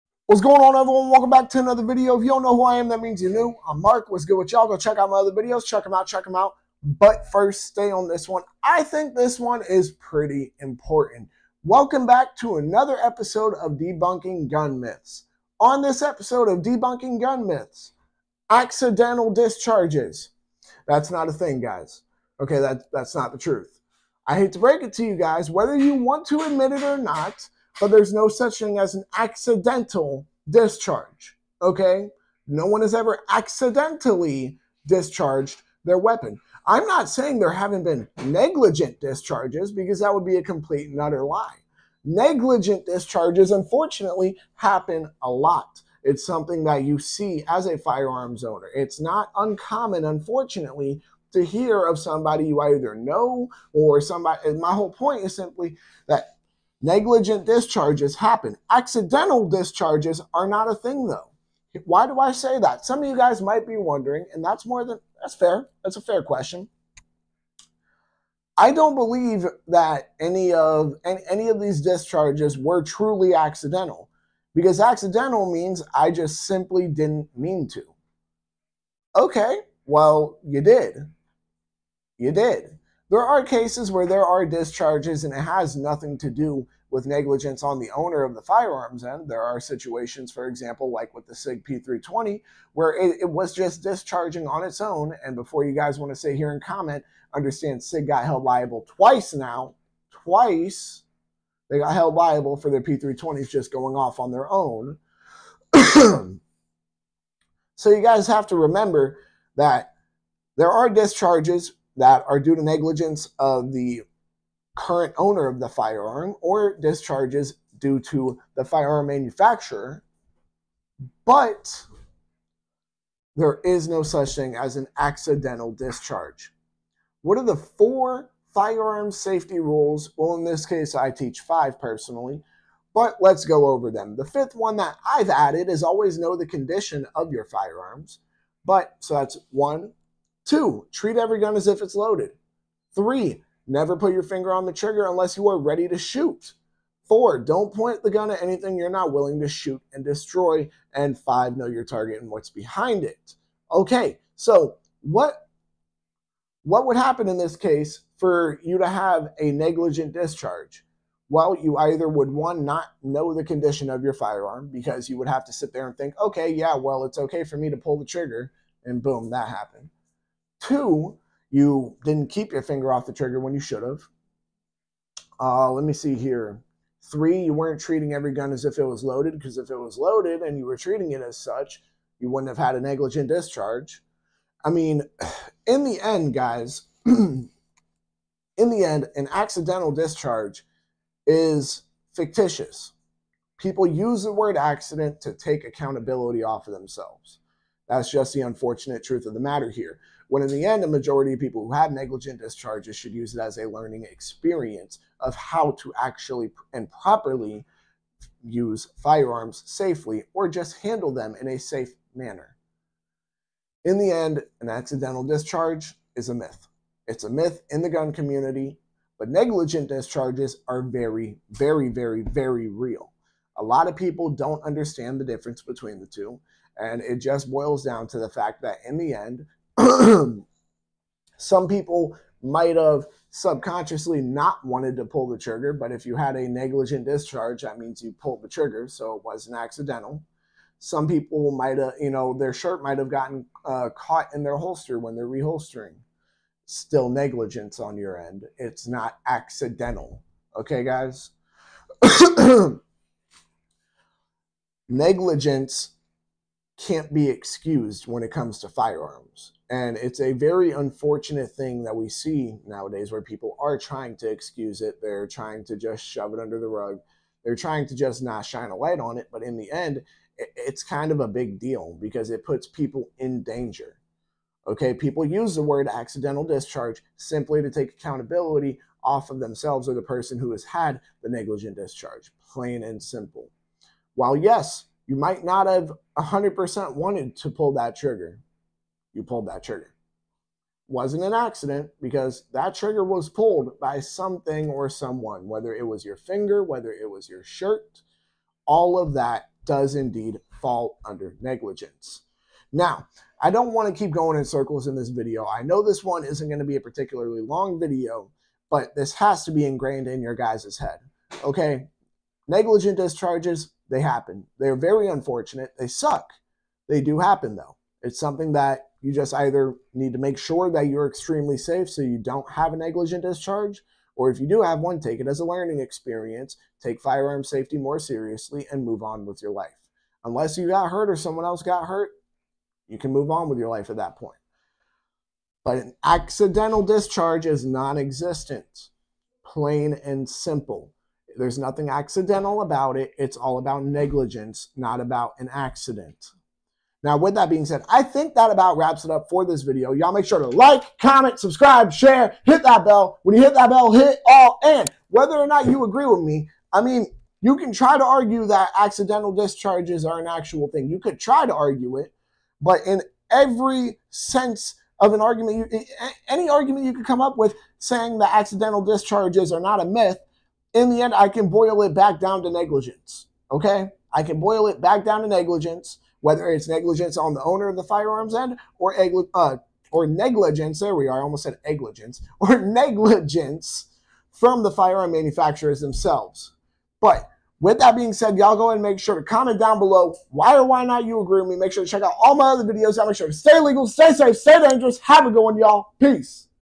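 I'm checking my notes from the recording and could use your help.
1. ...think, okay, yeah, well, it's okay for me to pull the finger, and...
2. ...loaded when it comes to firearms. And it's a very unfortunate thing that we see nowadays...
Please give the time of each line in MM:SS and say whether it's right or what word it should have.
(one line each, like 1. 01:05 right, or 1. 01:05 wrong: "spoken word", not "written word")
1. 02:45 wrong: "trigger", not "finger"
2. 04:17 wrong: "excused", not "loaded".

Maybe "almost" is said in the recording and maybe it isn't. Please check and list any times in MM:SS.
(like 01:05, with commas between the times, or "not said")
06:21.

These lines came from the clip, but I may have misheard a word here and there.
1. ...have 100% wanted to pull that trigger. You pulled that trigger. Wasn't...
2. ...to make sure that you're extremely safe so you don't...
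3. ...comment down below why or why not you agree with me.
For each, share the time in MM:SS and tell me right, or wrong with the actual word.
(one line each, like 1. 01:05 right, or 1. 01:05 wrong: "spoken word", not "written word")
1. 04:45 right
2. 05:20 right
3. 06:29 right.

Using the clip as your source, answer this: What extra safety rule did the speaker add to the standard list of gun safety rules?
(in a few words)
Always know the condition of your firearms.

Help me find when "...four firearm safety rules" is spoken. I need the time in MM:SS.
02:07.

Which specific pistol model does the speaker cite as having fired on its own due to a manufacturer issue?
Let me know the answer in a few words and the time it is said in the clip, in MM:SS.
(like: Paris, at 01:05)
SIG P320, at 01:31.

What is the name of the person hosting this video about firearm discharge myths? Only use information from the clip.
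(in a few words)
Mark.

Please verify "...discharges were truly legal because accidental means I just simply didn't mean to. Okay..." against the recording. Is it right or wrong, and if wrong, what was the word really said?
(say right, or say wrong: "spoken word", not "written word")
wrong: "accidental", not "legal".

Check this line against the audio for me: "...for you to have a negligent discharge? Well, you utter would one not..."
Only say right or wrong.
wrong.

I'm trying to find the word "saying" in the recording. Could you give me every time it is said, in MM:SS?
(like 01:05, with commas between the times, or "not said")
00:37, 06:07.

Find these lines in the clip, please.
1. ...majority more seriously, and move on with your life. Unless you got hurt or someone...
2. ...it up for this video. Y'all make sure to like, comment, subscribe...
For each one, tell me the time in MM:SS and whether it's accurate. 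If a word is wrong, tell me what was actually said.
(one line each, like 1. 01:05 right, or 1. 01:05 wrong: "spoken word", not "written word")
1. 05:27 wrong: "safety", not "majority"
2. 05:49 right.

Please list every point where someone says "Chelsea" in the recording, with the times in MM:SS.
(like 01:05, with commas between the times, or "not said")
not said.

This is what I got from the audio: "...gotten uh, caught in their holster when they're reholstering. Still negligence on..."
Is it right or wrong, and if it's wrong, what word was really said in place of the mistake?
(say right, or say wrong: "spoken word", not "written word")
right.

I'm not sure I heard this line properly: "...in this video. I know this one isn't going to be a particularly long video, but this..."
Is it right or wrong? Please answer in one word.
right.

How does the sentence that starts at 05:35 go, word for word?
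But an accidental discharge is non existent, plain and simple.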